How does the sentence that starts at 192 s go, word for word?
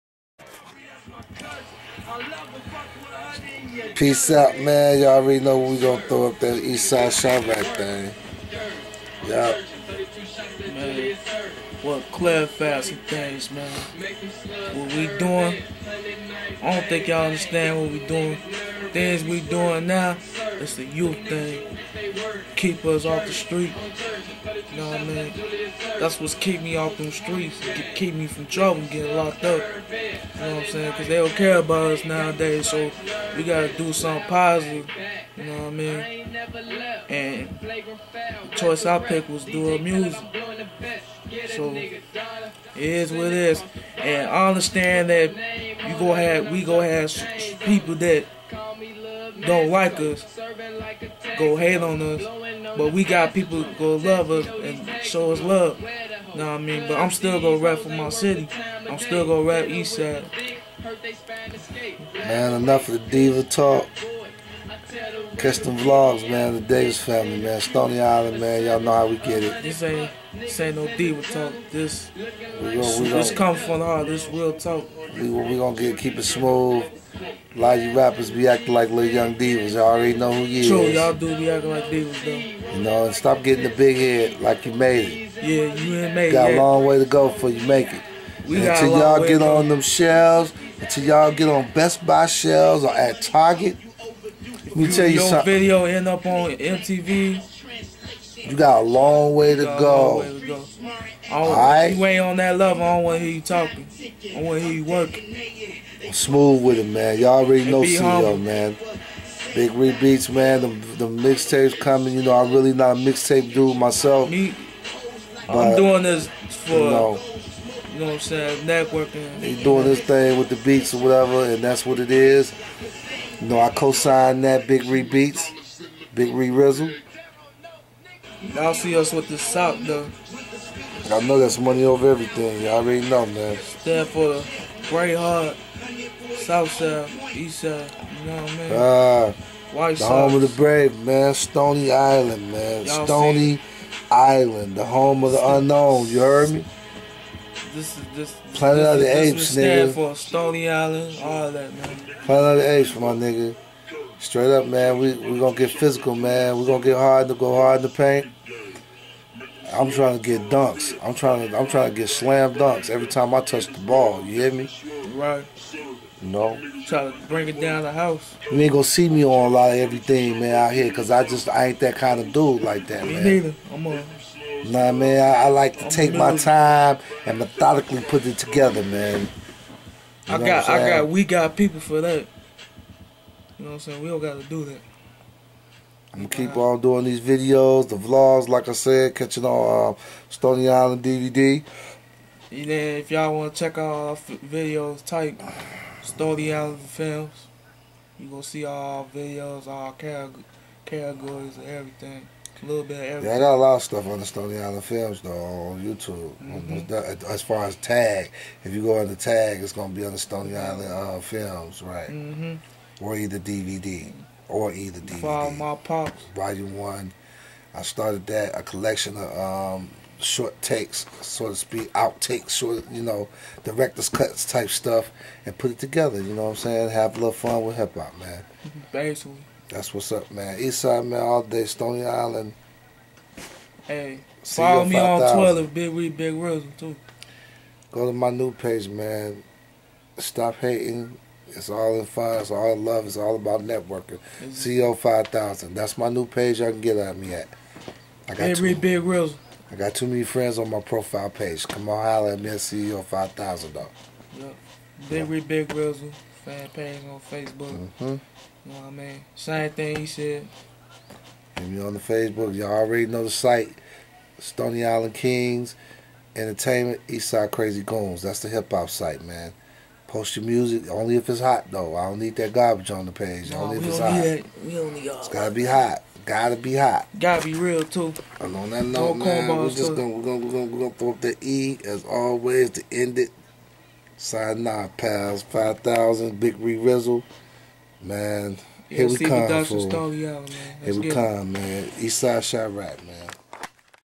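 And then if y'all want to check out our videos, type Stony Island Films.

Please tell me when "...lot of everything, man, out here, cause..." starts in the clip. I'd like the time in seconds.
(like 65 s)
169 s.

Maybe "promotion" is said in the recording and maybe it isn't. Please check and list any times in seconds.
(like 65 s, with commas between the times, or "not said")
not said.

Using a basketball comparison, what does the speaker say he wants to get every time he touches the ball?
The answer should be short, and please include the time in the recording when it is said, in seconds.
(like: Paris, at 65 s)
Slam dunks, at 162 s.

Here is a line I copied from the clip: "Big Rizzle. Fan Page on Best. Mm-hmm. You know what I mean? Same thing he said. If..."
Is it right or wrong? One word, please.
wrong.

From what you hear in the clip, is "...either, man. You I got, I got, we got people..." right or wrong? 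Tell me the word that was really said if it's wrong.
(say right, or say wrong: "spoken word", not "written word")
wrong: "together", not "either".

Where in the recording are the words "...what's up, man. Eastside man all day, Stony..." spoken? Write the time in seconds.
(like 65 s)
229 s.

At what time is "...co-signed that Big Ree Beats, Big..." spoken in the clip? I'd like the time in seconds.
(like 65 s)
123 s.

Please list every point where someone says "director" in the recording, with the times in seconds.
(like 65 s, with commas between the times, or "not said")
223 s.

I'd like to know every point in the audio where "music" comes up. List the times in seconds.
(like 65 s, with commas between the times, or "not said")
39 s, 270 s.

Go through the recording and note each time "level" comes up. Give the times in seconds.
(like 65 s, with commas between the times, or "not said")
102 s.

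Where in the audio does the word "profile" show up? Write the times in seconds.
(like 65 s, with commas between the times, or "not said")
250 s.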